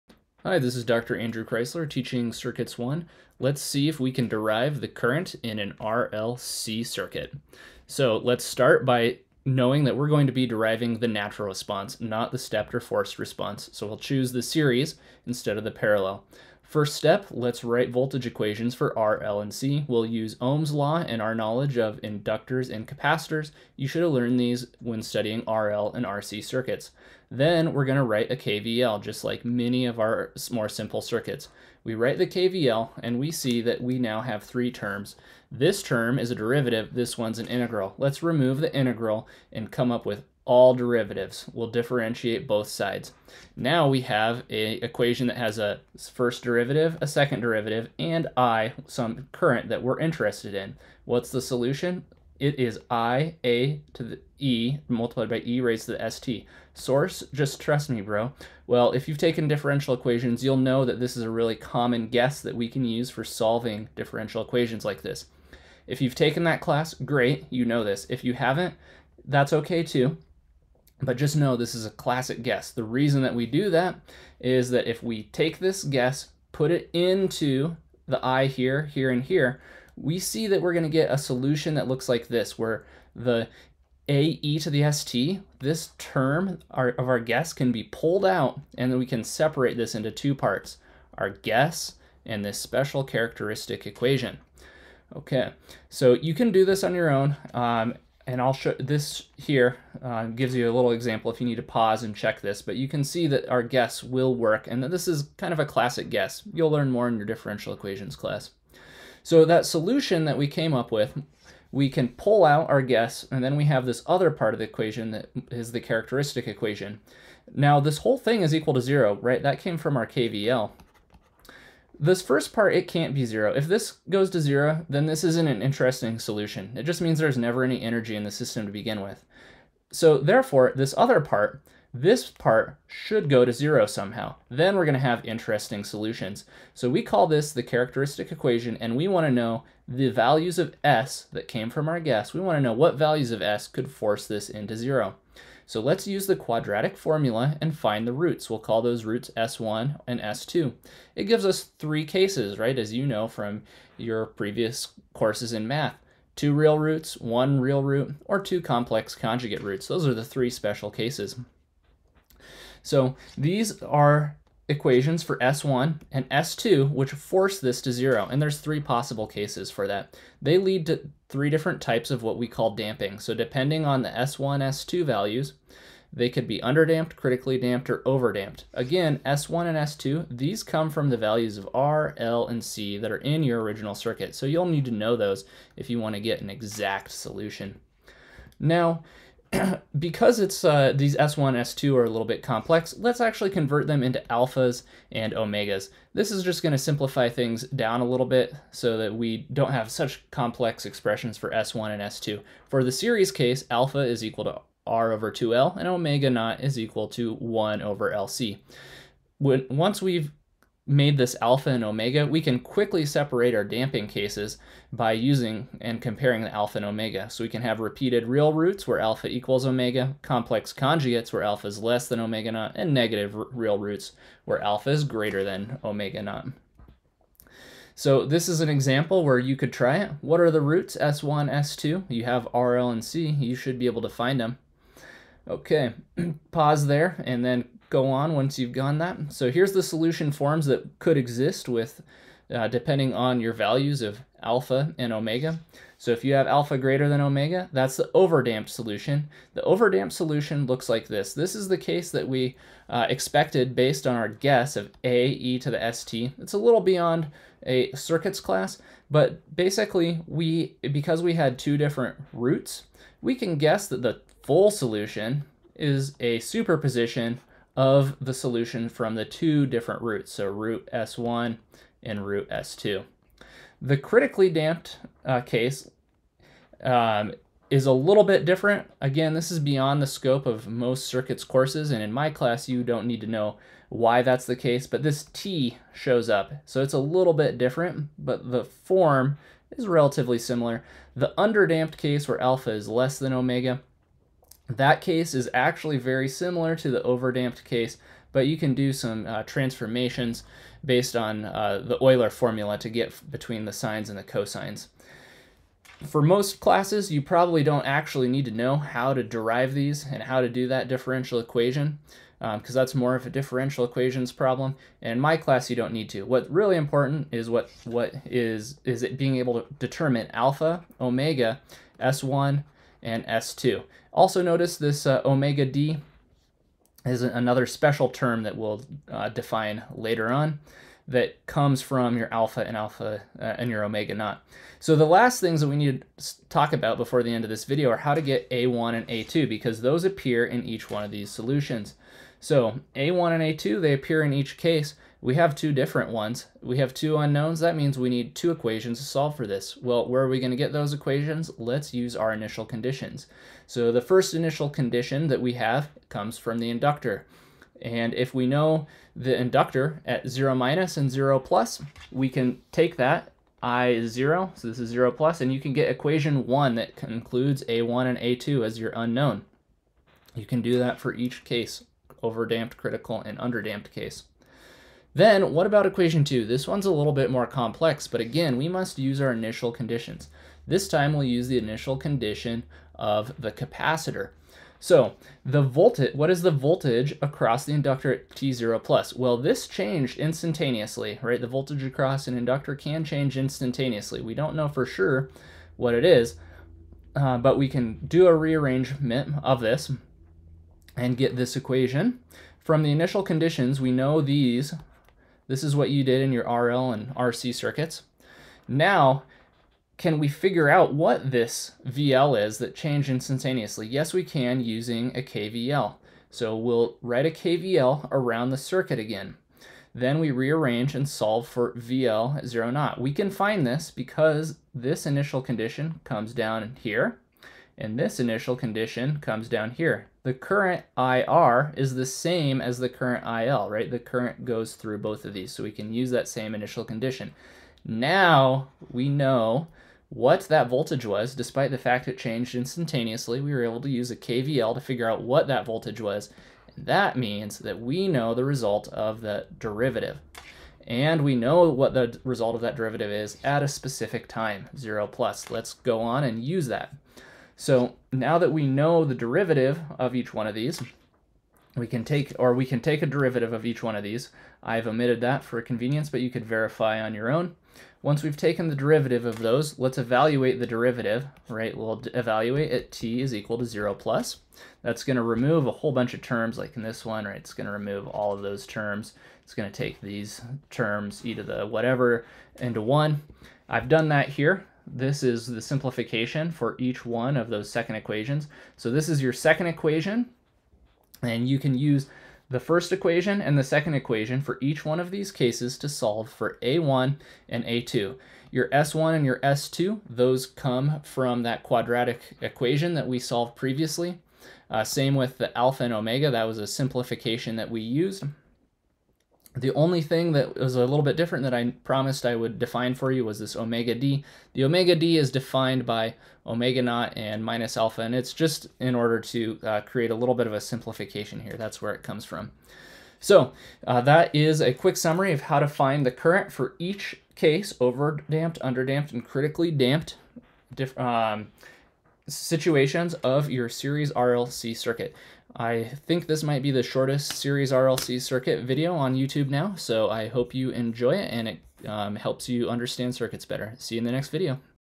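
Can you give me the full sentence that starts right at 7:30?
And we know what the result of that derivative is at a specific time, 0 plus.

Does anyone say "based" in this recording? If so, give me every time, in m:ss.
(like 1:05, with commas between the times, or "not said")
4:13, 5:00.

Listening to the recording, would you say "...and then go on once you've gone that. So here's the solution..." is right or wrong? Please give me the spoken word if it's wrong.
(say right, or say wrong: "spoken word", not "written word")
right.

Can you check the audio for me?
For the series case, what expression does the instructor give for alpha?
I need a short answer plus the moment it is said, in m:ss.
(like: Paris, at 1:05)
R over 2L, at 3:24.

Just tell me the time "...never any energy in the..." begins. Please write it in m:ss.
2:07.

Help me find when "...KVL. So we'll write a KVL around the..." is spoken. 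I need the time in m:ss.
6:55.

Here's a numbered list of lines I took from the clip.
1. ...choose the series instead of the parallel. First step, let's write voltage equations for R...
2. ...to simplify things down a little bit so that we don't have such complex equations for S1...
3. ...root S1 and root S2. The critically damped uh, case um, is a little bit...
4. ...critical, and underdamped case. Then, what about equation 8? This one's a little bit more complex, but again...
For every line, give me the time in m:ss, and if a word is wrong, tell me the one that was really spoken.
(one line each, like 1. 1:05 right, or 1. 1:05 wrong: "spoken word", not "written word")
1. 0:13 right
2. 3:16 wrong: "expressions", not "equations"
3. 4:30 right
4. 6:12 wrong: "2", not "8".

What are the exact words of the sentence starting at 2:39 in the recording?
Those are the three special cases.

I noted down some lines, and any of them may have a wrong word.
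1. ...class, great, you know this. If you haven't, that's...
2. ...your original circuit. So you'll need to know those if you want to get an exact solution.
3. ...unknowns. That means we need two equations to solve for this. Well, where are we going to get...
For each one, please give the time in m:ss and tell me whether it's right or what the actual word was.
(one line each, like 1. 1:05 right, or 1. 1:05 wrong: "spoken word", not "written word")
1. 1:06 right
2. 3:03 right
3. 5:47 right.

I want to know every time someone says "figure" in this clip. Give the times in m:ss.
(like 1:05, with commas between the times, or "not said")
6:50, 7:24.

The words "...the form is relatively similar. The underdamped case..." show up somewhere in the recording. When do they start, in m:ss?
4:48.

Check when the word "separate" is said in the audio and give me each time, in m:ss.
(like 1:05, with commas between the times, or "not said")
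1:29, 3:33.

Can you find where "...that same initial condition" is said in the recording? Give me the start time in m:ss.
7:16.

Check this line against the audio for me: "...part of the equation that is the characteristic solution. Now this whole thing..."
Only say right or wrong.
wrong.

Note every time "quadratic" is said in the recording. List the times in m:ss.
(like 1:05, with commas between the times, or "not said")
2:26, 8:21.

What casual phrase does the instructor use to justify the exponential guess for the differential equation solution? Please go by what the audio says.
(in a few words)
Just trust me, bro.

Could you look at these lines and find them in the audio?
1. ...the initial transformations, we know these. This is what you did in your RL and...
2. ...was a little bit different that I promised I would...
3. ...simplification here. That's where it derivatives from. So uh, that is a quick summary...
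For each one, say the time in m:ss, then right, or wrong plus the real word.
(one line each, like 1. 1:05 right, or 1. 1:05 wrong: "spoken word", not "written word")
1. 6:42 wrong: "conditions", not "transformations"
2. 8:30 right
3. 8:40 wrong: "comes", not "derivatives".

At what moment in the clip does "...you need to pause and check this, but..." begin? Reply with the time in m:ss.
1:41.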